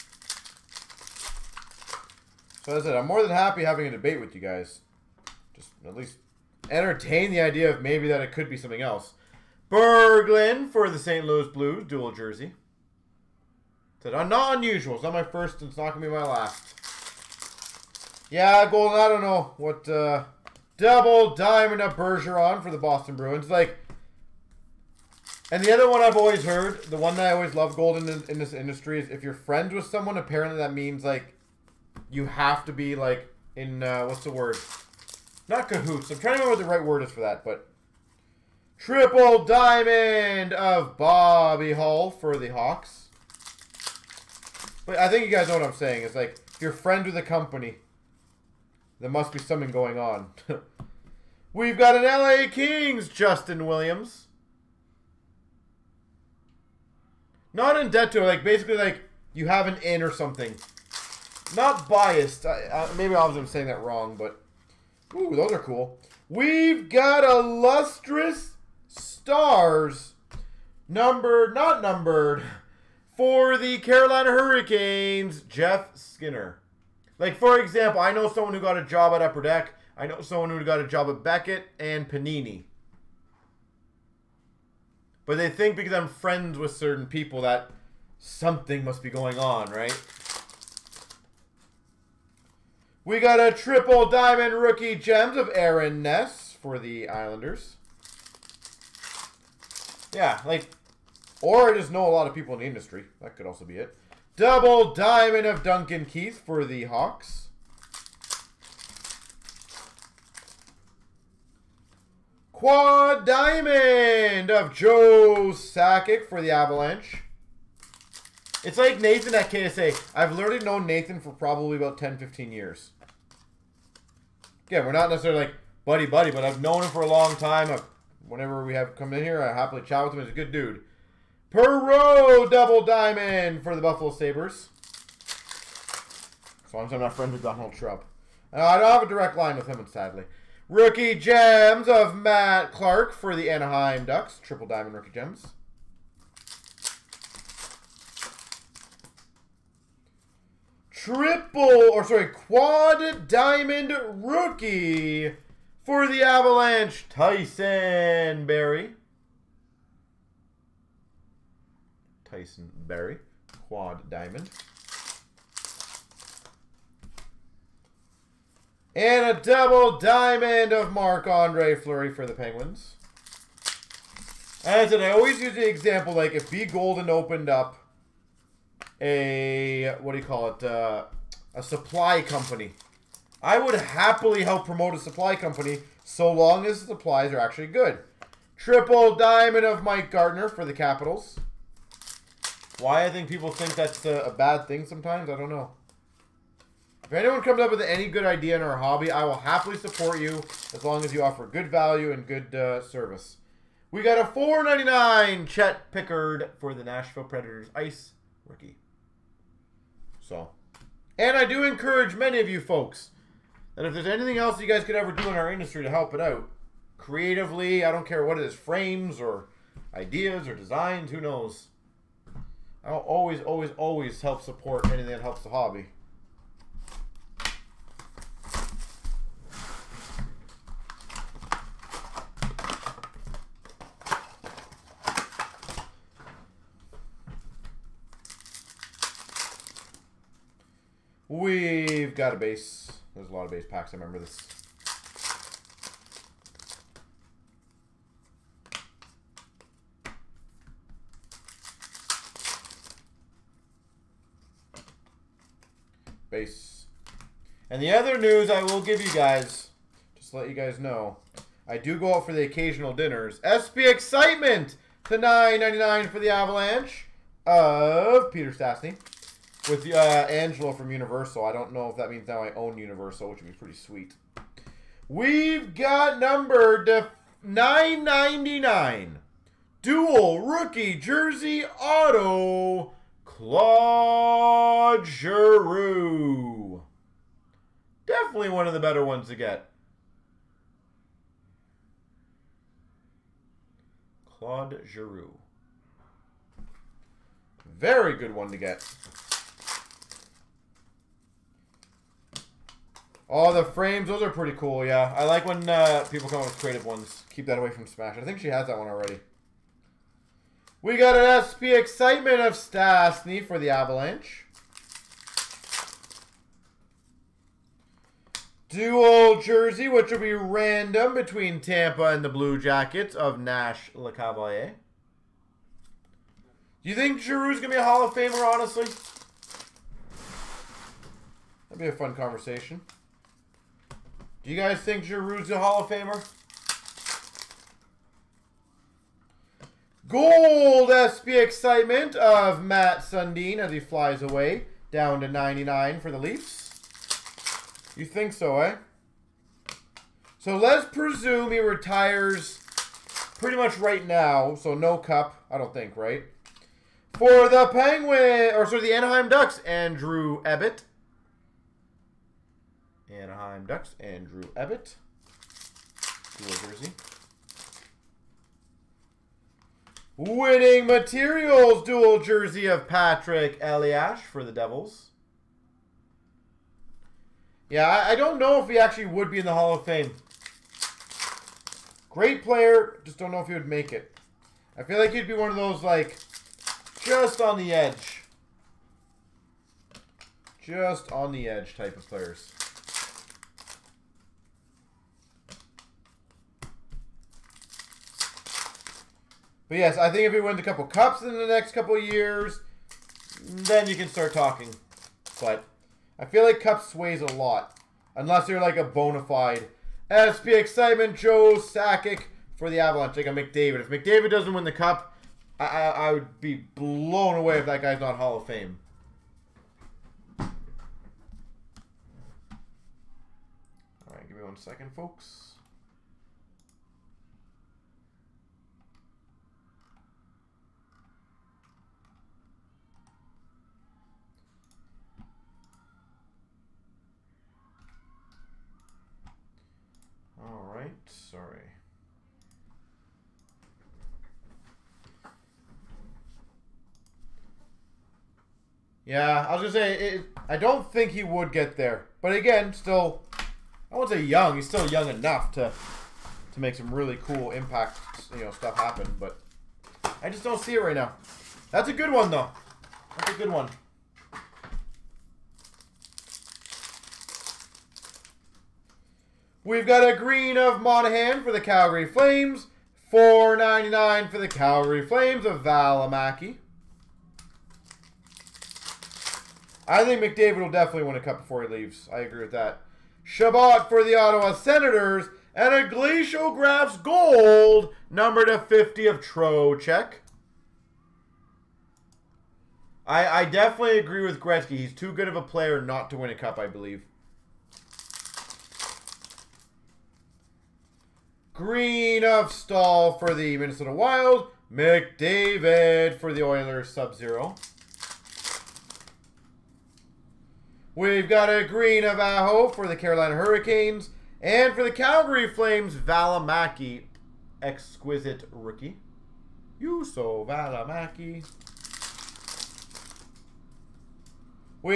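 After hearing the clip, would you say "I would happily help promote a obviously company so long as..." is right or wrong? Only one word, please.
wrong.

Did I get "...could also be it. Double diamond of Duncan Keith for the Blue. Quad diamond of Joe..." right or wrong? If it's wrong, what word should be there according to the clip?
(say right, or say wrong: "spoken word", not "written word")
wrong: "Hawks", not "Blue".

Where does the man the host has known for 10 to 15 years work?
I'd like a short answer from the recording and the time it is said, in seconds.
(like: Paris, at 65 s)
KSA, at 119 s.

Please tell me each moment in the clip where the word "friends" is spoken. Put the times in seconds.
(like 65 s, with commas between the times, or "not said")
29 s, 46 s, 86 s, 137 s.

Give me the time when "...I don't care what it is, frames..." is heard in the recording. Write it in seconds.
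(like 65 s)
217 s.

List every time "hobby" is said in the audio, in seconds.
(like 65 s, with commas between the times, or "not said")
198 s, 225 s.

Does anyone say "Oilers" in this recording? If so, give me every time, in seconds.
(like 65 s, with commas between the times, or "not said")
506 s.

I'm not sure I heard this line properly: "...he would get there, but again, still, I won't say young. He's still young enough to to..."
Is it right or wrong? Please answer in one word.
right.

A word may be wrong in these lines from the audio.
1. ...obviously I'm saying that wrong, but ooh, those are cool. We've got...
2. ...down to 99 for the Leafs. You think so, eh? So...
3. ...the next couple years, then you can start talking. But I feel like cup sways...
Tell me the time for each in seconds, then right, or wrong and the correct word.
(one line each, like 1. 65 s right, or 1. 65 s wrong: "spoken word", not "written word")
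1. 63 s right
2. 344 s right
3. 401 s right.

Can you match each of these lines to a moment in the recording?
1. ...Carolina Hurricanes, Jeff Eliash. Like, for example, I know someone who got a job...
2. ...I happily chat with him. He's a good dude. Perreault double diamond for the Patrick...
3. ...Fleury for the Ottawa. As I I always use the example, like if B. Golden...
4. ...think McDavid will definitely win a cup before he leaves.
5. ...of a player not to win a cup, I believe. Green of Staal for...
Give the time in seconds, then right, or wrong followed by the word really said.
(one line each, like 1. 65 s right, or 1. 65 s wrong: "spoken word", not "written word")
1. 73 s wrong: "Skinner", not "Eliash"
2. 129 s wrong: "Buffalo", not "Patrick"
3. 171 s wrong: "Penguins", not "Ottawa"
4. 480 s right
5. 495 s right.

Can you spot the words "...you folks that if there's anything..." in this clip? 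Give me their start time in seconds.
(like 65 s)
212 s.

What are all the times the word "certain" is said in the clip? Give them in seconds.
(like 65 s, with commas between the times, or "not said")
86 s.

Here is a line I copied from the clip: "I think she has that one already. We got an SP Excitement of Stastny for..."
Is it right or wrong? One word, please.
right.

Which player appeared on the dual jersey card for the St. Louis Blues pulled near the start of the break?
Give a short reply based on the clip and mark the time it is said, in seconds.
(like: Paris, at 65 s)
Berglund, at 9 s.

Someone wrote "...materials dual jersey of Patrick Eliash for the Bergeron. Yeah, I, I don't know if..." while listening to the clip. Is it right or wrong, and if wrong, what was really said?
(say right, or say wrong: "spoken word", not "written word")
wrong: "Devils", not "Bergeron".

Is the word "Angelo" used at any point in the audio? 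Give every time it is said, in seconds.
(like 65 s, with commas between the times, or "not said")
269 s.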